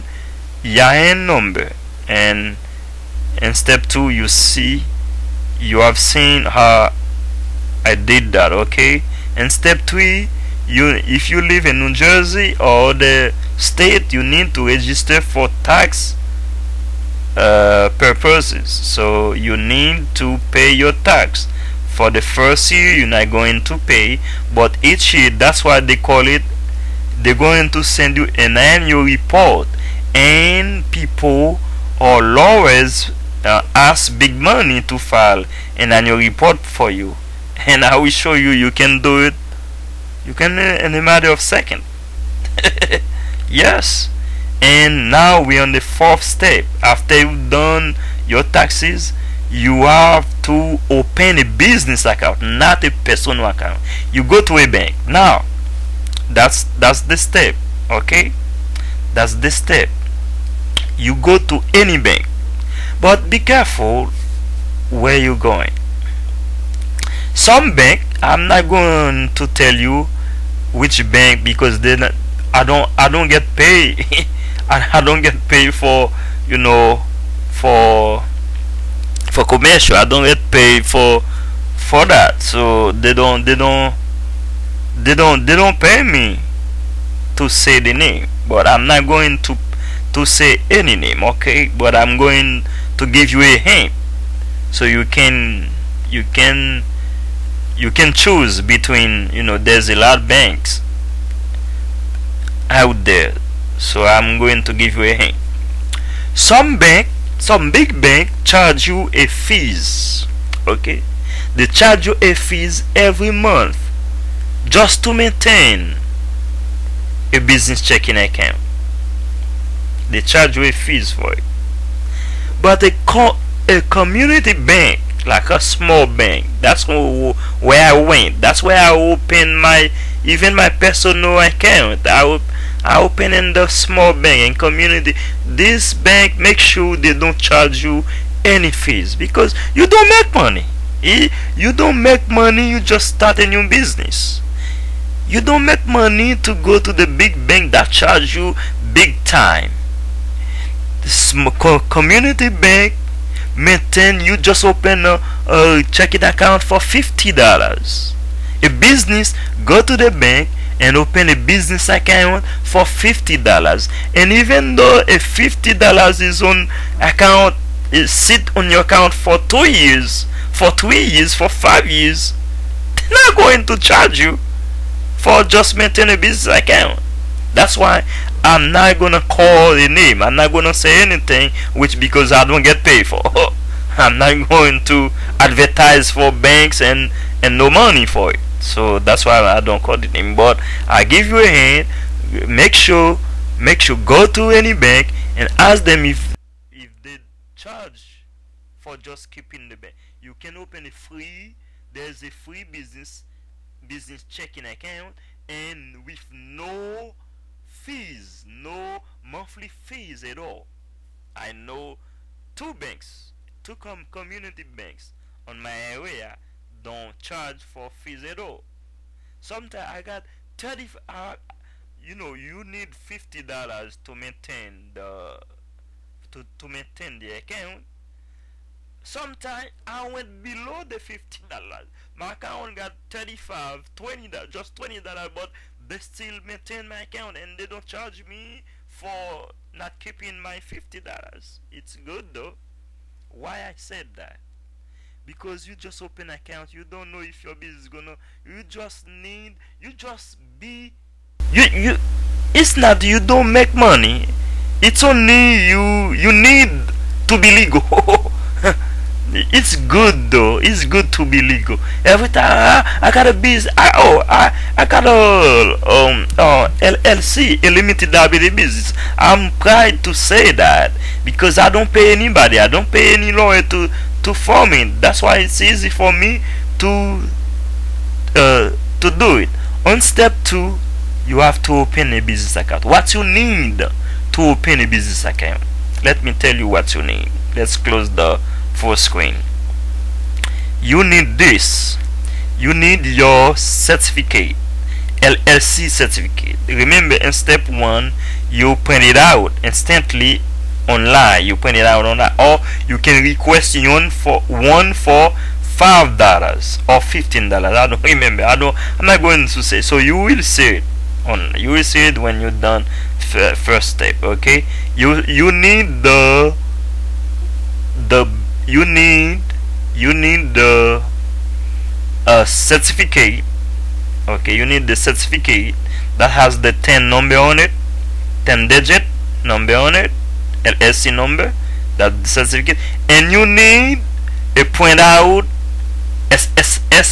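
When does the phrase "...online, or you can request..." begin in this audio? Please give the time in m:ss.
5:02.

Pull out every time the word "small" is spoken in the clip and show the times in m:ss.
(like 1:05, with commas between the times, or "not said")
2:05, 2:13.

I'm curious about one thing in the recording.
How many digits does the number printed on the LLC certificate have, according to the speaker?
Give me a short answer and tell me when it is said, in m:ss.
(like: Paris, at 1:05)
10, at 5:28.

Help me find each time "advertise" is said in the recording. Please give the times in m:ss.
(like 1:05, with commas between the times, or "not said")
3:05.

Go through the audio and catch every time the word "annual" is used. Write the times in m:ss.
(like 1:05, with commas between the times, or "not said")
0:28, 0:35.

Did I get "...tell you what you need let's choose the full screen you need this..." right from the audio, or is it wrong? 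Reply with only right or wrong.
wrong.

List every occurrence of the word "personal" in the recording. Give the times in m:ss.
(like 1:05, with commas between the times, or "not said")
0:53, 2:10.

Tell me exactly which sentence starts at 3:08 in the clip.
So that's why I don't call the name.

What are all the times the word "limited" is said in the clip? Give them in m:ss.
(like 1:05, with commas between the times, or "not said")
4:27.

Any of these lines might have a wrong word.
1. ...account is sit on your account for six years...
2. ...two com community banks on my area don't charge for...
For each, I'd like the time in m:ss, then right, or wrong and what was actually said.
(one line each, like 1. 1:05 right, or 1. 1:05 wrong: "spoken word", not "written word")
1. 2:47 wrong: "two", not "six"
2. 3:33 right.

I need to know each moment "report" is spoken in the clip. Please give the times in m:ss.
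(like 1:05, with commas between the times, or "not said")
0:29, 0:36.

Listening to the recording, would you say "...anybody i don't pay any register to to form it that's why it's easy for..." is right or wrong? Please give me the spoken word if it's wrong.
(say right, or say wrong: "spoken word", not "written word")
wrong: "lawyer", not "register".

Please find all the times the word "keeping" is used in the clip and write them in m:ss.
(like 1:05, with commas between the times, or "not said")
3:19, 3:59.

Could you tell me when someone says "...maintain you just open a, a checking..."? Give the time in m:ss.
2:33.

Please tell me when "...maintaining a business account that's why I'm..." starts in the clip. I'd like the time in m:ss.
2:55.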